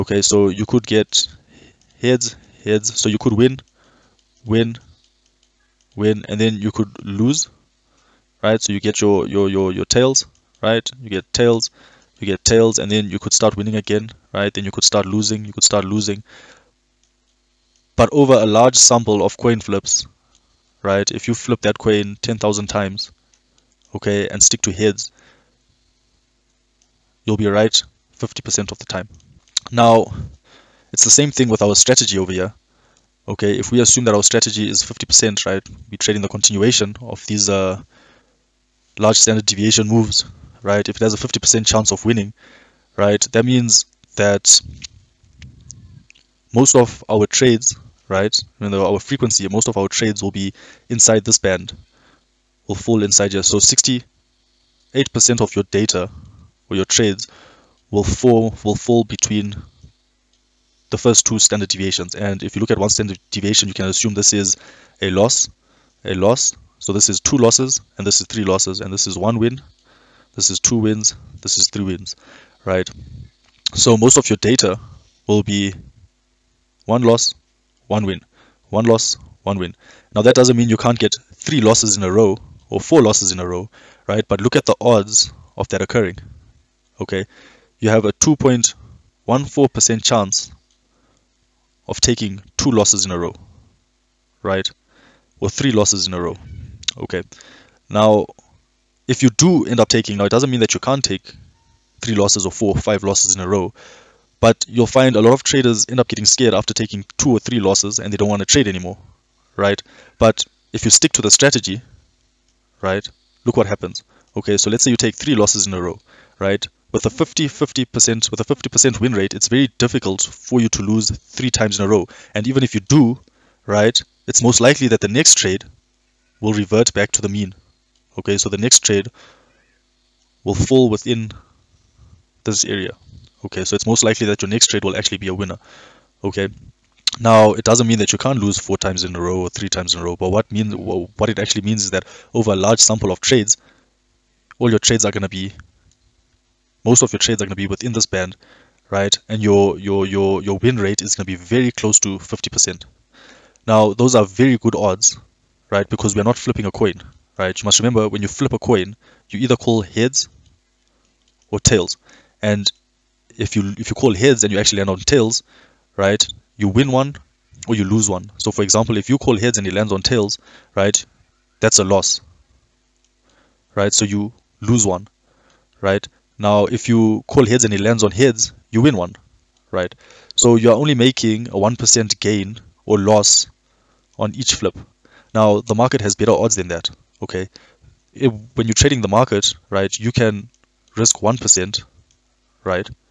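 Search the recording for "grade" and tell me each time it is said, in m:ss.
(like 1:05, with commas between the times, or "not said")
not said.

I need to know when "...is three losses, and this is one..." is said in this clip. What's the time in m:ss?
1:08.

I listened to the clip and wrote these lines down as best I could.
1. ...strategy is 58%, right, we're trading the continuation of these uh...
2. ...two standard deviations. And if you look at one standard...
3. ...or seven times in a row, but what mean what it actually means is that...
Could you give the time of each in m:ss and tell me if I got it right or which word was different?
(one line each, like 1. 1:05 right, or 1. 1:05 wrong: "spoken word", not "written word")
1. 0:34 wrong: "50", not "58"
2. 1:01 right
3. 2:19 wrong: "three", not "seven".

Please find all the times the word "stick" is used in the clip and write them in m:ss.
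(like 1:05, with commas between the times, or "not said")
0:24, 1:50.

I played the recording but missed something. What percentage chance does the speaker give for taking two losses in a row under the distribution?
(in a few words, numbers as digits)
2.14%.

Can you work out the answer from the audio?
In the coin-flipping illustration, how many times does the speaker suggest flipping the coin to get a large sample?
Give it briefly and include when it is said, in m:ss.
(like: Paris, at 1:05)
10,000, at 0:22.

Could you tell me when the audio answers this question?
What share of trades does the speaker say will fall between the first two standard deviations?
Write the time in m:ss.
0:53.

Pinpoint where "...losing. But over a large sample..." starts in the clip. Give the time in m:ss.
0:15.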